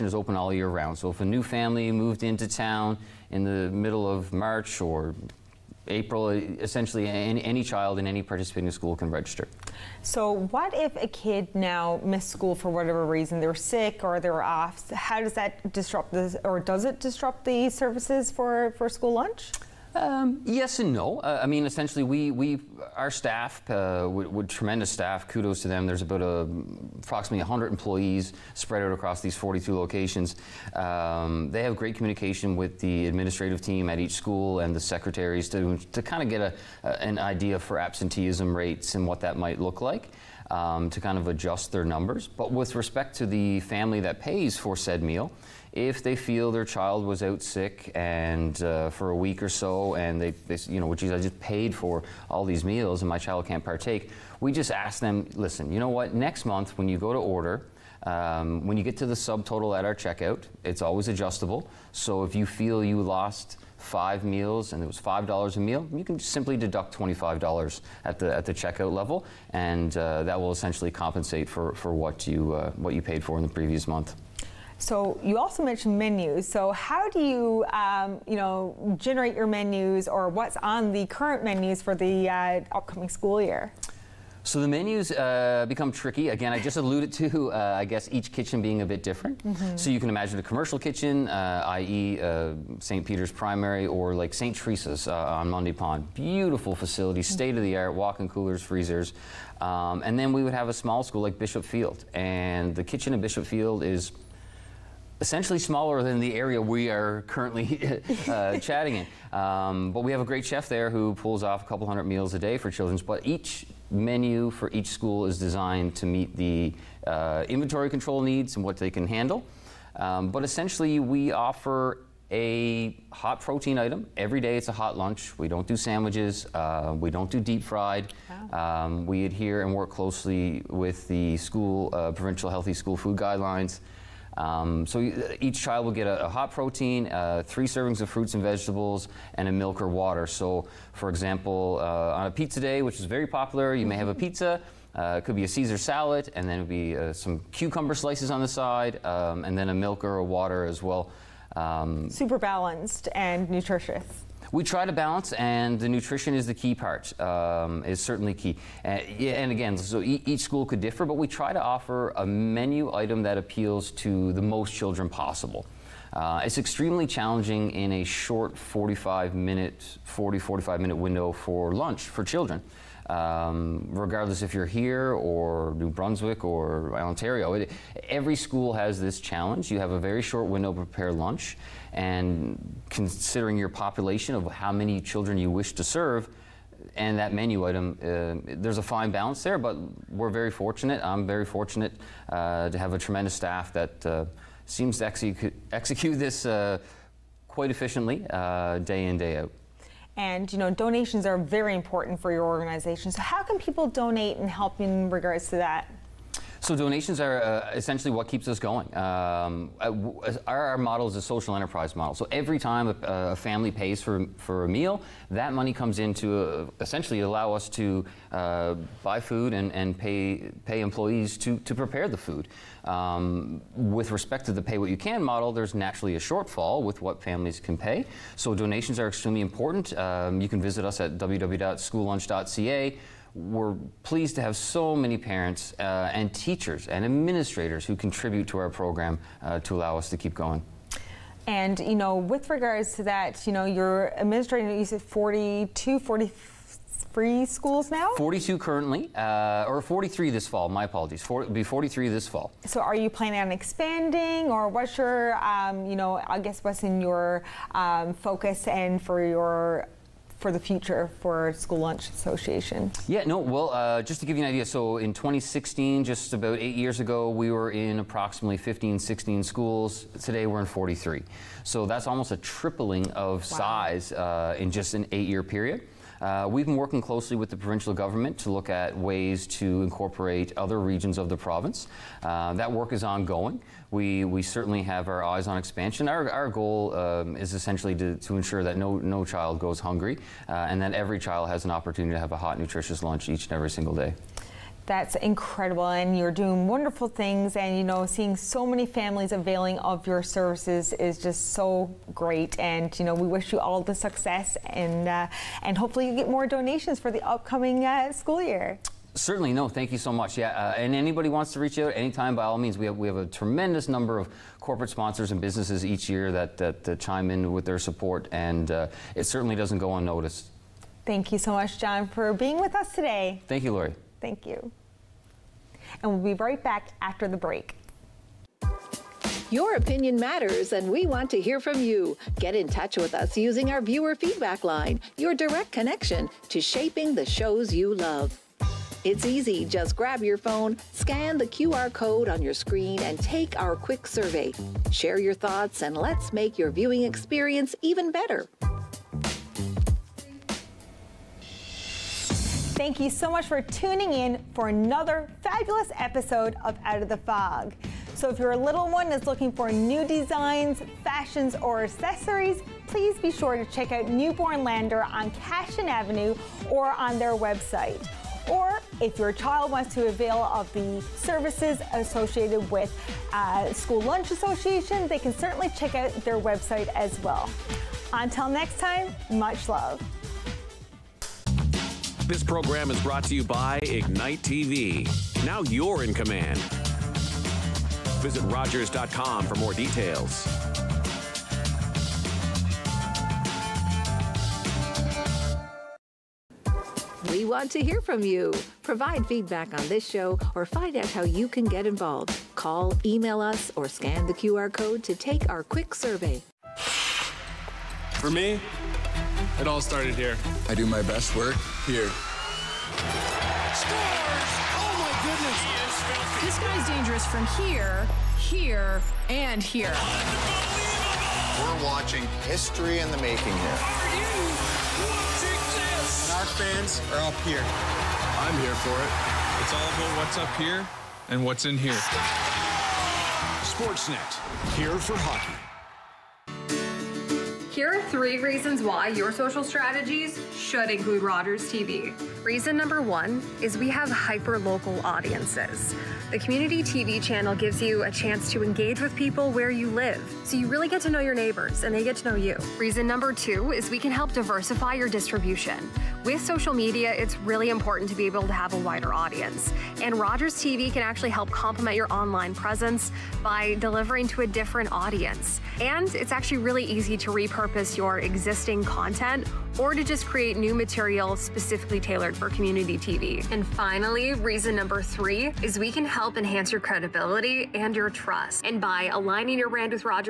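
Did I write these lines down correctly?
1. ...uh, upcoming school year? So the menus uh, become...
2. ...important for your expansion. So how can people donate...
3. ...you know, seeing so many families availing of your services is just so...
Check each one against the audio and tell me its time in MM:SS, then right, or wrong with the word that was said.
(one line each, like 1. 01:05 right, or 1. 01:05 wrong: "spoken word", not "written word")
1. 01:22 right
2. 03:21 wrong: "organization", not "expansion"
3. 04:57 right.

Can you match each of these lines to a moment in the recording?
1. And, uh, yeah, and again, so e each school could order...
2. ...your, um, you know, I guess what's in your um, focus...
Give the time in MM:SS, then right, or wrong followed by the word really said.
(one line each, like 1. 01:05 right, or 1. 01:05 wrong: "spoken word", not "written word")
1. 02:38 wrong: "differ", not "order"
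2. 04:14 right.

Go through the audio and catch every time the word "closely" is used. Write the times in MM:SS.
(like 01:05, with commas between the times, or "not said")
02:09, 04:37.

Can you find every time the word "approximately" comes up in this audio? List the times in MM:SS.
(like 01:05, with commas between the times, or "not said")
00:26, 04:27.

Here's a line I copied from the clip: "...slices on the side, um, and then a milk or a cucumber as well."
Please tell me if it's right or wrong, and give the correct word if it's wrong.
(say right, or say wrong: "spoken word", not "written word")
wrong: "water", not "cucumber".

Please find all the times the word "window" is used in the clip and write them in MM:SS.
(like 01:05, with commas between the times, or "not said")
02:50, 03:00.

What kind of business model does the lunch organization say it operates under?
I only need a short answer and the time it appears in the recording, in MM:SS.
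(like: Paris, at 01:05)
Social enterprise, at 03:31.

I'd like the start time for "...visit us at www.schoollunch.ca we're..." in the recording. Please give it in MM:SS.
03:50.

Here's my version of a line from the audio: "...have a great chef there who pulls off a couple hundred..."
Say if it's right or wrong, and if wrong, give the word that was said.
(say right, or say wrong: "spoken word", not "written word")
right.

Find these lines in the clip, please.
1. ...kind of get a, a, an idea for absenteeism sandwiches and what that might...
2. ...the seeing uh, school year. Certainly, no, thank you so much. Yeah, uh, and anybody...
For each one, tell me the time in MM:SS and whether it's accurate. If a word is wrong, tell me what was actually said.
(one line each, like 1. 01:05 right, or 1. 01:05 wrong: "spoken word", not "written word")
1. 00:36 wrong: "rates", not "sandwiches"
2. 05:07 wrong: "upcoming", not "seeing".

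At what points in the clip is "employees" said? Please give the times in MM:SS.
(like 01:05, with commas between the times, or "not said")
00:27, 03:40.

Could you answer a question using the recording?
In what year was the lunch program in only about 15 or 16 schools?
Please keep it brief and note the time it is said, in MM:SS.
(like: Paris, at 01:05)
2016, at 04:25.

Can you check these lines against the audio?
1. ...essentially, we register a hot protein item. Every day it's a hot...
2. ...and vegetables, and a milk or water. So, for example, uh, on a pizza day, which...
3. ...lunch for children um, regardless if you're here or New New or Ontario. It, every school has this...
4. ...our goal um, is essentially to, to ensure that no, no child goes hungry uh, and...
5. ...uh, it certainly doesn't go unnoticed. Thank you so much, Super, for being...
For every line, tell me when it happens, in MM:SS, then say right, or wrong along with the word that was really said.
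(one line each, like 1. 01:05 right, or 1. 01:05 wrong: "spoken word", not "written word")
1. 02:00 wrong: "offer", not "register"
2. 02:18 right
3. 02:51 wrong: "Brunswick", not "New"
4. 04:46 right
5. 05:18 wrong: "John", not "Super".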